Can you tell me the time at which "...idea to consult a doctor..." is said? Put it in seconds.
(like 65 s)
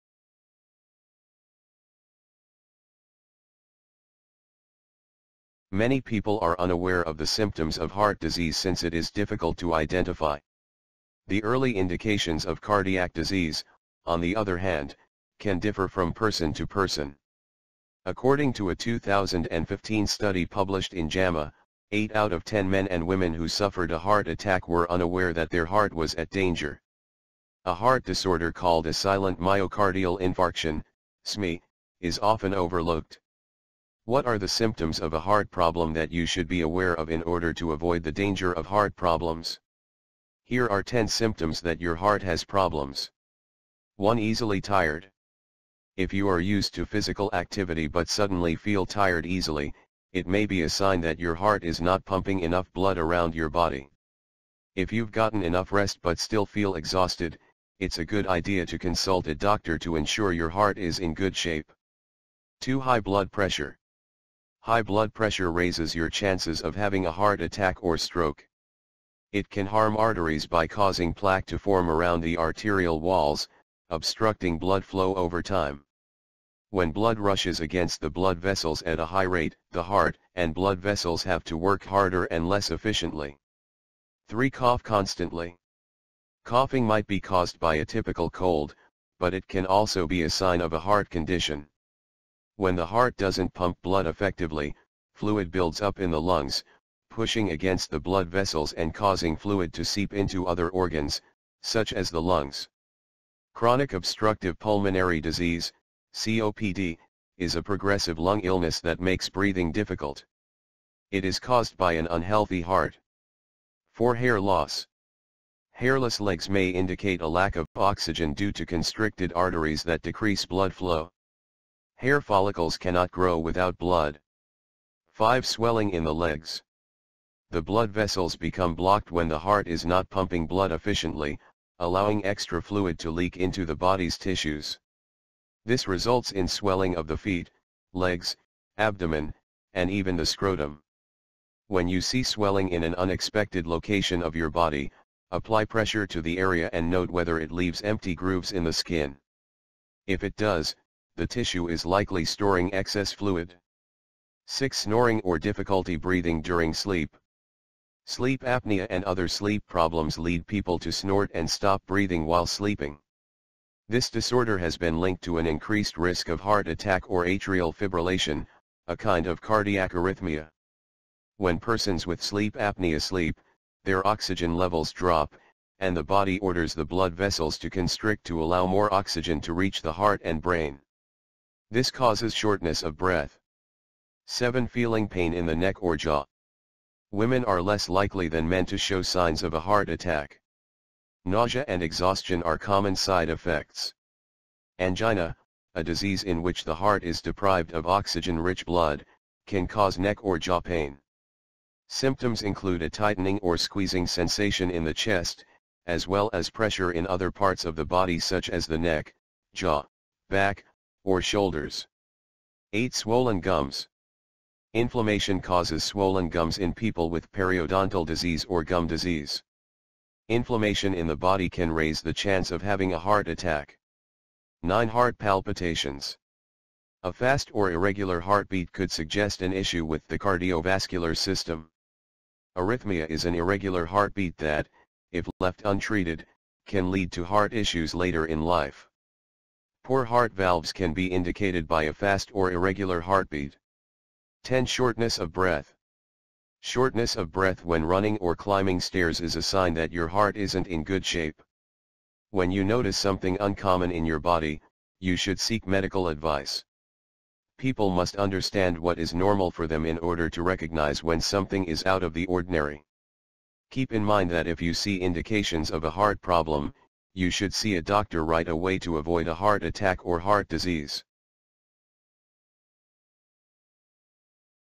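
58 s.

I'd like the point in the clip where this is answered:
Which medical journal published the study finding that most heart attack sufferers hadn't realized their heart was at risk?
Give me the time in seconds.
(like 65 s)
21 s.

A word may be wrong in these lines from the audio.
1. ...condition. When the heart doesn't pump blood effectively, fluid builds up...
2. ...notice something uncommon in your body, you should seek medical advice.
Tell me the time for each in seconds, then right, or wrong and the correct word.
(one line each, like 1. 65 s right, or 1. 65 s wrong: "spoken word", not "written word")
1. 91 s right
2. 252 s right.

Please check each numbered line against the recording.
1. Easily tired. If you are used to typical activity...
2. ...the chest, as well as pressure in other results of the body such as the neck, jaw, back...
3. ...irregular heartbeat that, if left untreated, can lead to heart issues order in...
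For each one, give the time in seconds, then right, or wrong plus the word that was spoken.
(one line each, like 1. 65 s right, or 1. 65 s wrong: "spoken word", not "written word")
1. 44 s wrong: "physical", not "typical"
2. 204 s wrong: "parts", not "results"
3. 233 s wrong: "later", not "order".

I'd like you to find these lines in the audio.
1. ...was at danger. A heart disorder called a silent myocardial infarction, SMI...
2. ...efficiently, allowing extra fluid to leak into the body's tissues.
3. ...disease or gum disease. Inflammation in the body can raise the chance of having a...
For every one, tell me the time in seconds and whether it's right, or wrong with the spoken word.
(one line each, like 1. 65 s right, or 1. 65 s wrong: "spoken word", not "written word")
1. 25 s right
2. 130 s right
3. 218 s right.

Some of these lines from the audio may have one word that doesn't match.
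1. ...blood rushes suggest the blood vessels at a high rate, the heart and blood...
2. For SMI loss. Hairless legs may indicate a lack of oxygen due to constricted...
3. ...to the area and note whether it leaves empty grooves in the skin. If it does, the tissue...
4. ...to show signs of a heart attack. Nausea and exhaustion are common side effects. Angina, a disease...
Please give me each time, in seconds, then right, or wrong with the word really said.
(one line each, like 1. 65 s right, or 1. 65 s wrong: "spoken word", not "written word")
1. 76 s wrong: "against", not "suggest"
2. 113 s wrong: "Hair", not "SMI"
3. 146 s right
4. 188 s right.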